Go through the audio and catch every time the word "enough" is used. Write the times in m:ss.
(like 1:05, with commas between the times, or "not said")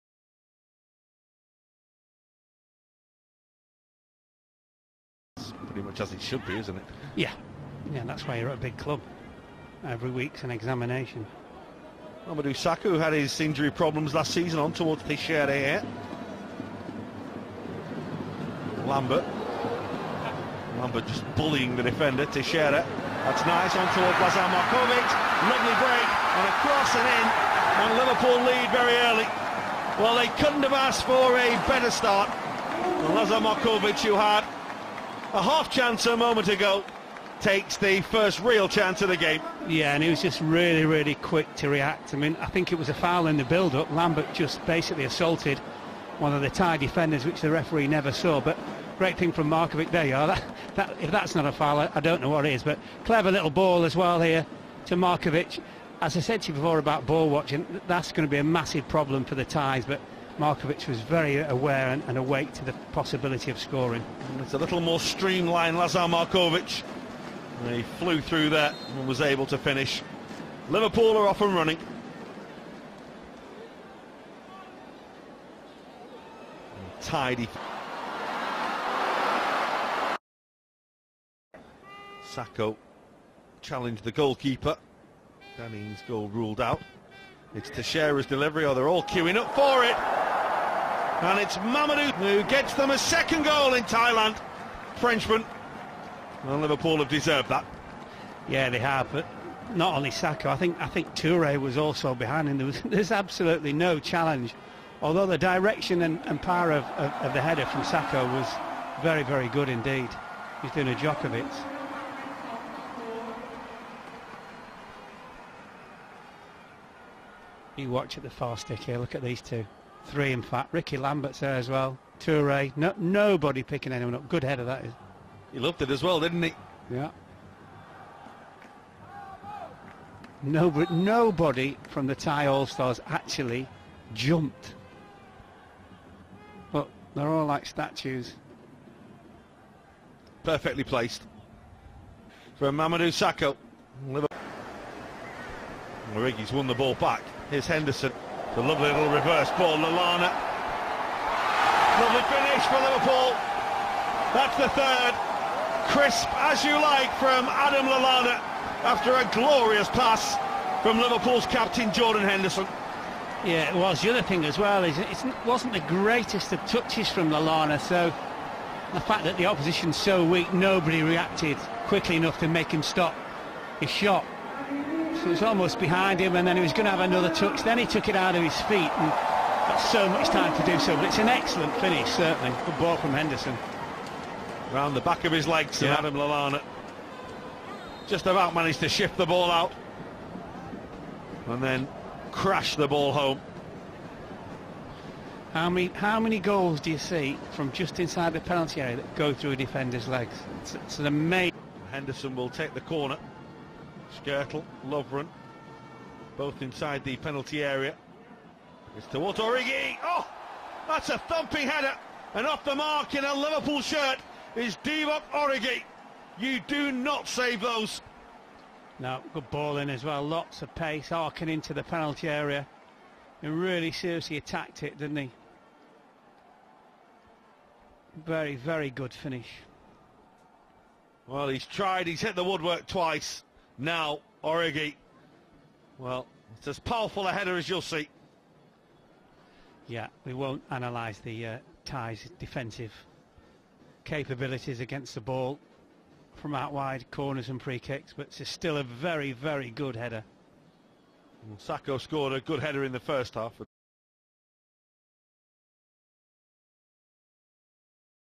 2:52.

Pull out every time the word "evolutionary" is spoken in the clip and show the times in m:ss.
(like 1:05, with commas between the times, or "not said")
not said.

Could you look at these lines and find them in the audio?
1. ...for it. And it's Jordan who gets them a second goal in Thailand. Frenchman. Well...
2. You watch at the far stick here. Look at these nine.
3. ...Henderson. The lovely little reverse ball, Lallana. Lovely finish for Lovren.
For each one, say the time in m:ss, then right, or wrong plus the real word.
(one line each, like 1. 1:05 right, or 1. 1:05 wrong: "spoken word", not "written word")
1. 1:29 wrong: "Mamadou", not "Jordan"
2. 1:57 wrong: "two", not "nine"
3. 2:27 wrong: "Liverpool", not "Lovren".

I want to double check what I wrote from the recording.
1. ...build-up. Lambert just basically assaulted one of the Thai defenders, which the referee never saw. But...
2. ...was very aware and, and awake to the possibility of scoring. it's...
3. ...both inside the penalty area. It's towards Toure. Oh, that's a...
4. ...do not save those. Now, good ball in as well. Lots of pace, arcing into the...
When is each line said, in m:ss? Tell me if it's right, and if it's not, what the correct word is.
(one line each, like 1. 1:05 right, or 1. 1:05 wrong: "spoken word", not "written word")
1. 0:43 right
2. 1:00 right
3. 3:26 wrong: "Origi", not "Toure"
4. 3:36 right.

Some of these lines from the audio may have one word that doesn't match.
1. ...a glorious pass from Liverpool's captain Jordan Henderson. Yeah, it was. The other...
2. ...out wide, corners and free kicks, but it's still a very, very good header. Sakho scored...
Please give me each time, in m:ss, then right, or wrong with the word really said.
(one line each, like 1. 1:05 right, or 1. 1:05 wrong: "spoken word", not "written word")
1. 2:39 right
2. 4:06 right.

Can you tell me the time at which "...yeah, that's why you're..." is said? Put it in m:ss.
0:07.